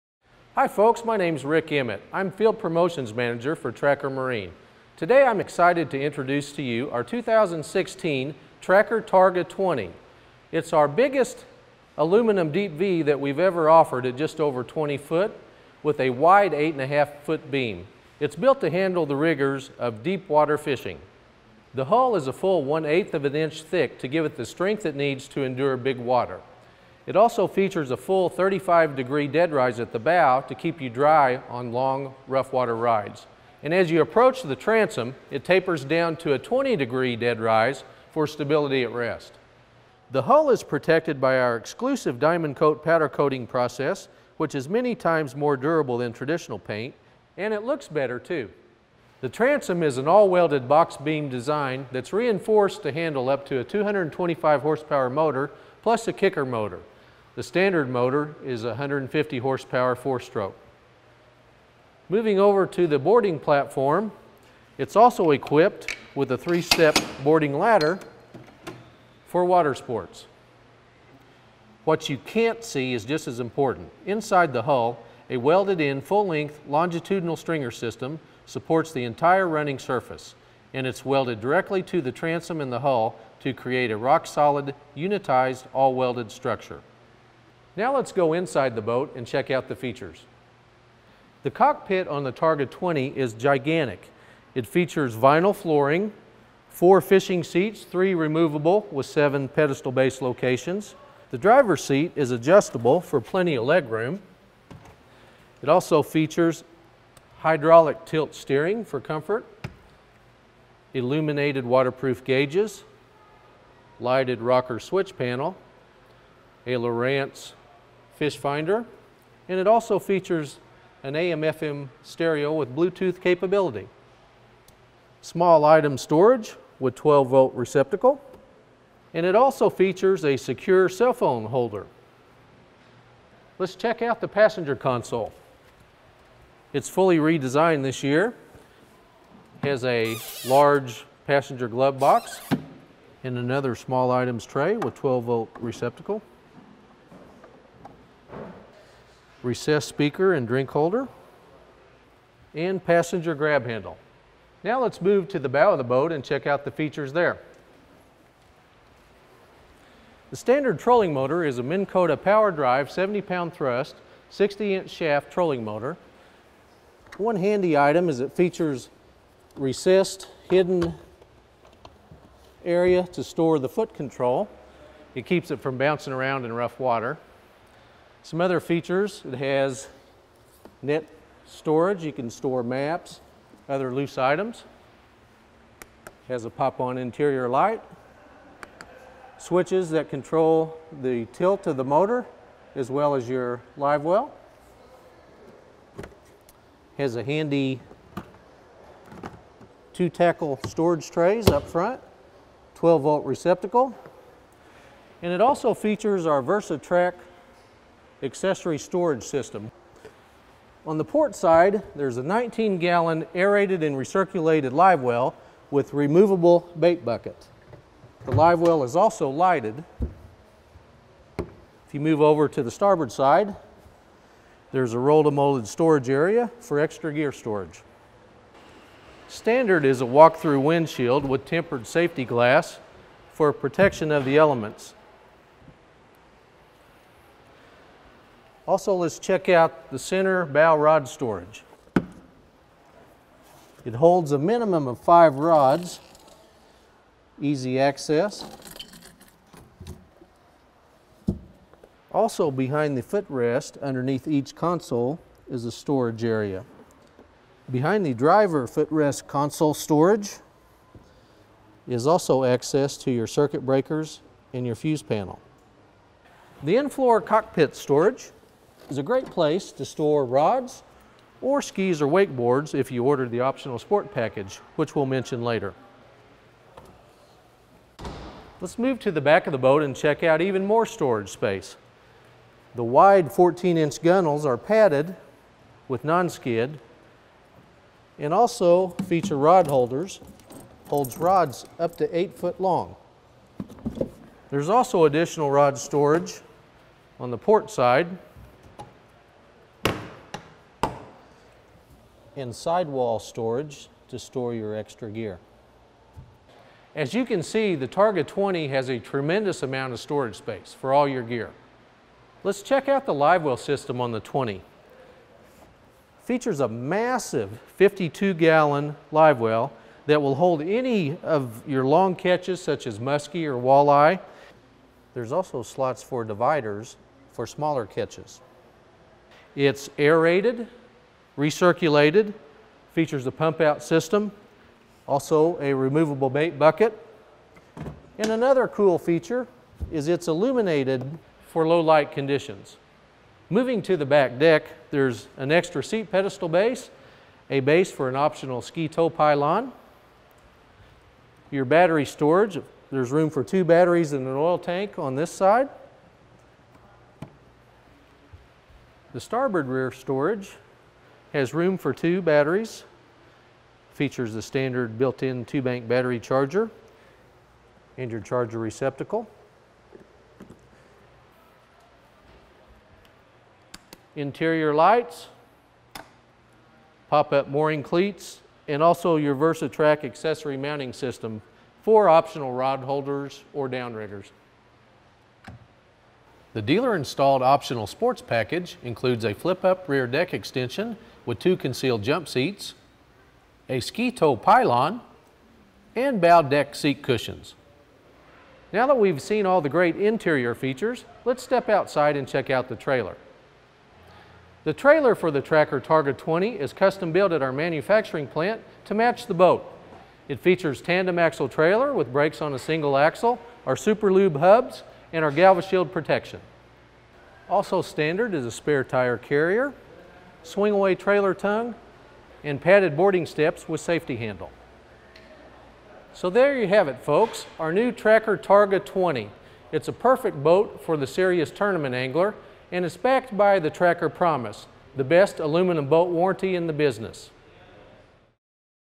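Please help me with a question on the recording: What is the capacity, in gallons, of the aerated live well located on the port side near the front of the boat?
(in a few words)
19.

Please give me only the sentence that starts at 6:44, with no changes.
The trailer for the Tracker Targa 20 is custom built at our manufacturing plant to match the boat.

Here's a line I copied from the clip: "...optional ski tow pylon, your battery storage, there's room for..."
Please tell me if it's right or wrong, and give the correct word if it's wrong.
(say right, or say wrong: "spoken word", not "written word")
right.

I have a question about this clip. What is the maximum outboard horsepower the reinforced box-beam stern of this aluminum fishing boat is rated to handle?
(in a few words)
225.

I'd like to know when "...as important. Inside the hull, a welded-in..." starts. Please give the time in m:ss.
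1:13.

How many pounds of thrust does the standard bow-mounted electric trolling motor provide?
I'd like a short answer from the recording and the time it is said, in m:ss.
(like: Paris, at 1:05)
70, at 2:42.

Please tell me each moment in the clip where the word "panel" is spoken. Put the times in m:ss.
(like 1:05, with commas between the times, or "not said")
1:55, 4:25.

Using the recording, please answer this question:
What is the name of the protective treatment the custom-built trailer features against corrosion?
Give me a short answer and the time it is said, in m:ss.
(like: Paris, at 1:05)
GalvaShield, at 6:55.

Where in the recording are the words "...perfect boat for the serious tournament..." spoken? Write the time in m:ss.
7:09.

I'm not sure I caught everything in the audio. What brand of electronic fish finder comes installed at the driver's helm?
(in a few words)
Lowrance.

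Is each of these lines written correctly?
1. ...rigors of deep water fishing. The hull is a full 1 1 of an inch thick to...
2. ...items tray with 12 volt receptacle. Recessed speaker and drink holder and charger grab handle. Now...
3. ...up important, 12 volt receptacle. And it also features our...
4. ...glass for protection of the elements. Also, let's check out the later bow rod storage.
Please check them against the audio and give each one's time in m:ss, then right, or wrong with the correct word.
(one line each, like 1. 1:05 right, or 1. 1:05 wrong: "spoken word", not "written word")
1. 0:19 wrong: "8", not "1"
2. 2:24 wrong: "passenger", not "charger"
3. 3:21 wrong: "front", not "important"
4. 3:52 wrong: "center", not "later".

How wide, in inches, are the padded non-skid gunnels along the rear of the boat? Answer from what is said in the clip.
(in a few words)
14.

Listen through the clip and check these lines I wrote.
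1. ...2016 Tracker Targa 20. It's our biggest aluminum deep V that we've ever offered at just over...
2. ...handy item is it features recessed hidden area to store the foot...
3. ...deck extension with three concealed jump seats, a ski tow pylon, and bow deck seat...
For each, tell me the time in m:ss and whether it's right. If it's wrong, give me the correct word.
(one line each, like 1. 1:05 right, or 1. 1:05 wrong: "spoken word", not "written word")
1. 0:07 right
2. 2:47 right
3. 6:30 wrong: "two", not "three".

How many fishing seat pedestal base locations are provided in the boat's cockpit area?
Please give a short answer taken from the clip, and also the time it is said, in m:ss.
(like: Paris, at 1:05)
7, at 1:39.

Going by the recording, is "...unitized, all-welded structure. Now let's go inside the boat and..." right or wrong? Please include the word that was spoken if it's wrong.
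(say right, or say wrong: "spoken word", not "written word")
right.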